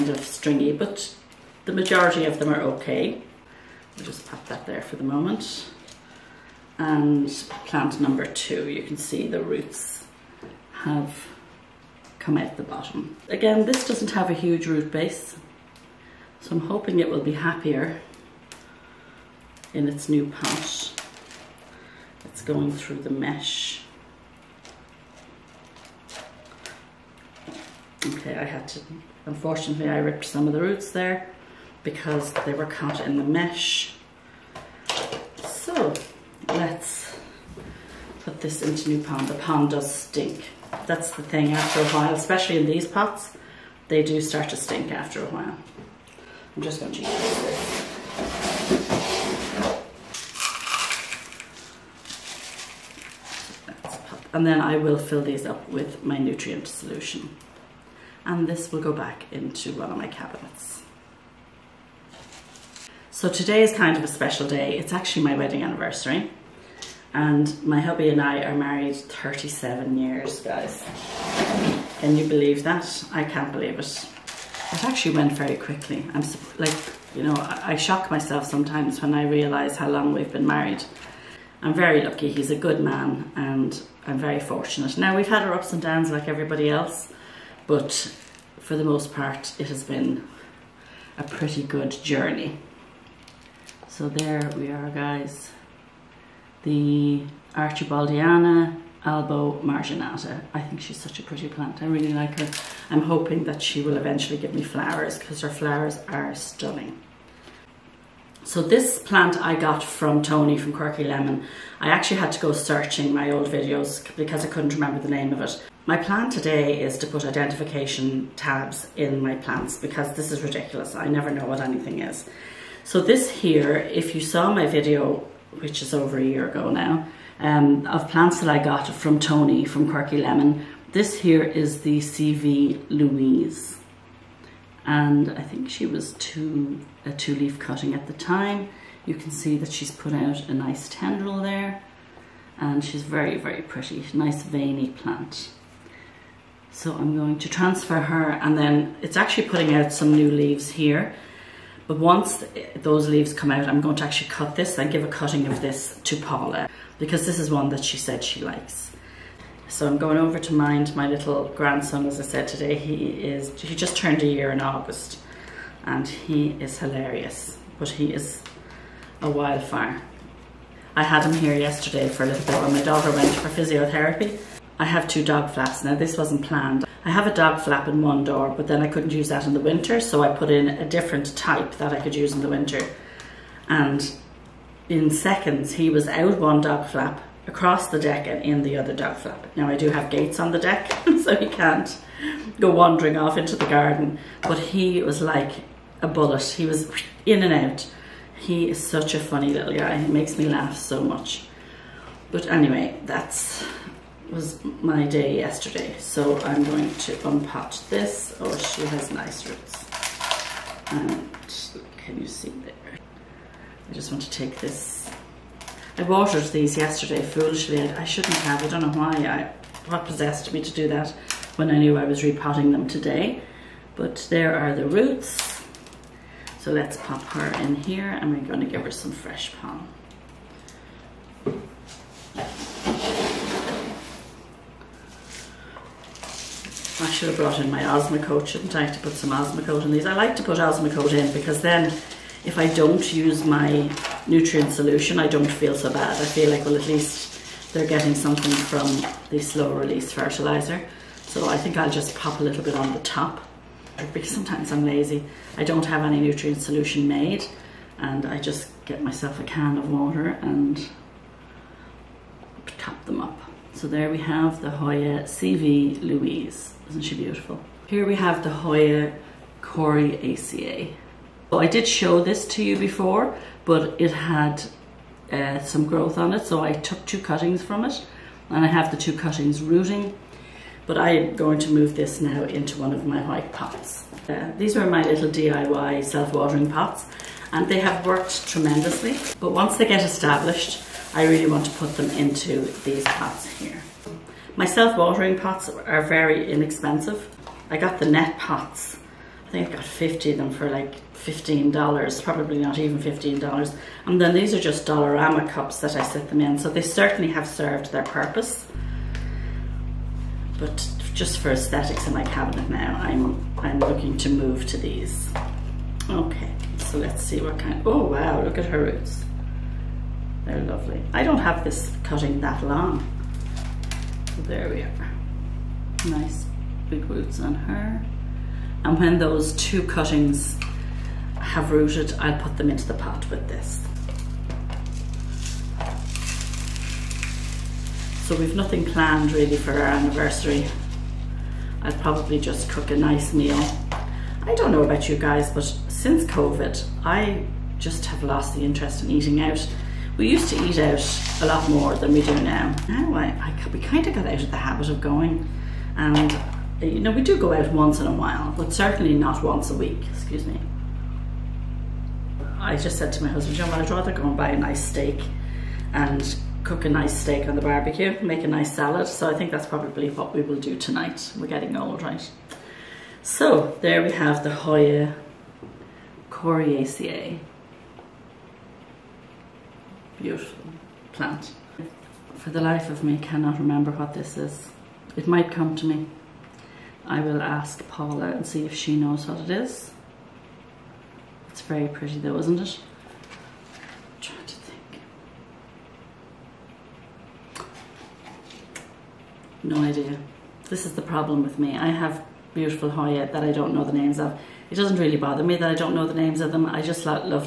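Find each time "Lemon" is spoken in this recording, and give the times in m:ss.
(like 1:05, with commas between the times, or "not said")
1:51, 2:10.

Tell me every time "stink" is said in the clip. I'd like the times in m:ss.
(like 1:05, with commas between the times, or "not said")
0:39, 0:44.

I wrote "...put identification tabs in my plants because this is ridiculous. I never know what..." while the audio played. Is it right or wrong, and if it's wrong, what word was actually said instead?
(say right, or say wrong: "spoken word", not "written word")
right.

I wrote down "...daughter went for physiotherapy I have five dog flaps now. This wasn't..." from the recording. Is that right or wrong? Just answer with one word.
wrong.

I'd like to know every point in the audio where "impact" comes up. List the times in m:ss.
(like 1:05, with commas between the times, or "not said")
not said.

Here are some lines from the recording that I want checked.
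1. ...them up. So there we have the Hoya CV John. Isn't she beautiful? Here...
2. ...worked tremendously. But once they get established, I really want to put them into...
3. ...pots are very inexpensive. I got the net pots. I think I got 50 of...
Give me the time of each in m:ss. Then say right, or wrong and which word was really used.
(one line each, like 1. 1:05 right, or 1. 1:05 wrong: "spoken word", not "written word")
1. 4:23 wrong: "Louise", not "John"
2. 4:48 right
3. 4:55 right.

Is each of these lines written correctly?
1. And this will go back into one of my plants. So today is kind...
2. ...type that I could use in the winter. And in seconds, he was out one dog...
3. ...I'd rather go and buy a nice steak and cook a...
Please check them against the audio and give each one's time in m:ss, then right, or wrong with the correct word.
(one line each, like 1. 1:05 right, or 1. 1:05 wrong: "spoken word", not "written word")
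1. 0:58 wrong: "cabinets", not "plants"
2. 3:01 right
3. 6:03 right.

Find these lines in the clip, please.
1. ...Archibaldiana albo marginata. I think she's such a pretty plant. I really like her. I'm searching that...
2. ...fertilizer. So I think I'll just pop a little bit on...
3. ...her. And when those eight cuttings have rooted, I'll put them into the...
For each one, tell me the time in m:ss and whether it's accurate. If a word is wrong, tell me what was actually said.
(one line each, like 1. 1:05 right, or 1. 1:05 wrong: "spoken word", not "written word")
1. 1:37 wrong: "hoping", not "searching"
2. 4:10 right
3. 5:27 wrong: "two", not "eight".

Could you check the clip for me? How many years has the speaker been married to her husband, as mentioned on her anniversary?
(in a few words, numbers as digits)
37.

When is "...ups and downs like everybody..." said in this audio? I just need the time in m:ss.
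1:25.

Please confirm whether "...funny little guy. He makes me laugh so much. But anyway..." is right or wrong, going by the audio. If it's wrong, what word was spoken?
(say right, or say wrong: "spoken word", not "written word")
right.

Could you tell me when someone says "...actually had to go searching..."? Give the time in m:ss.
1:51.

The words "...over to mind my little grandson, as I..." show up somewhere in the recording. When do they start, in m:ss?
2:40.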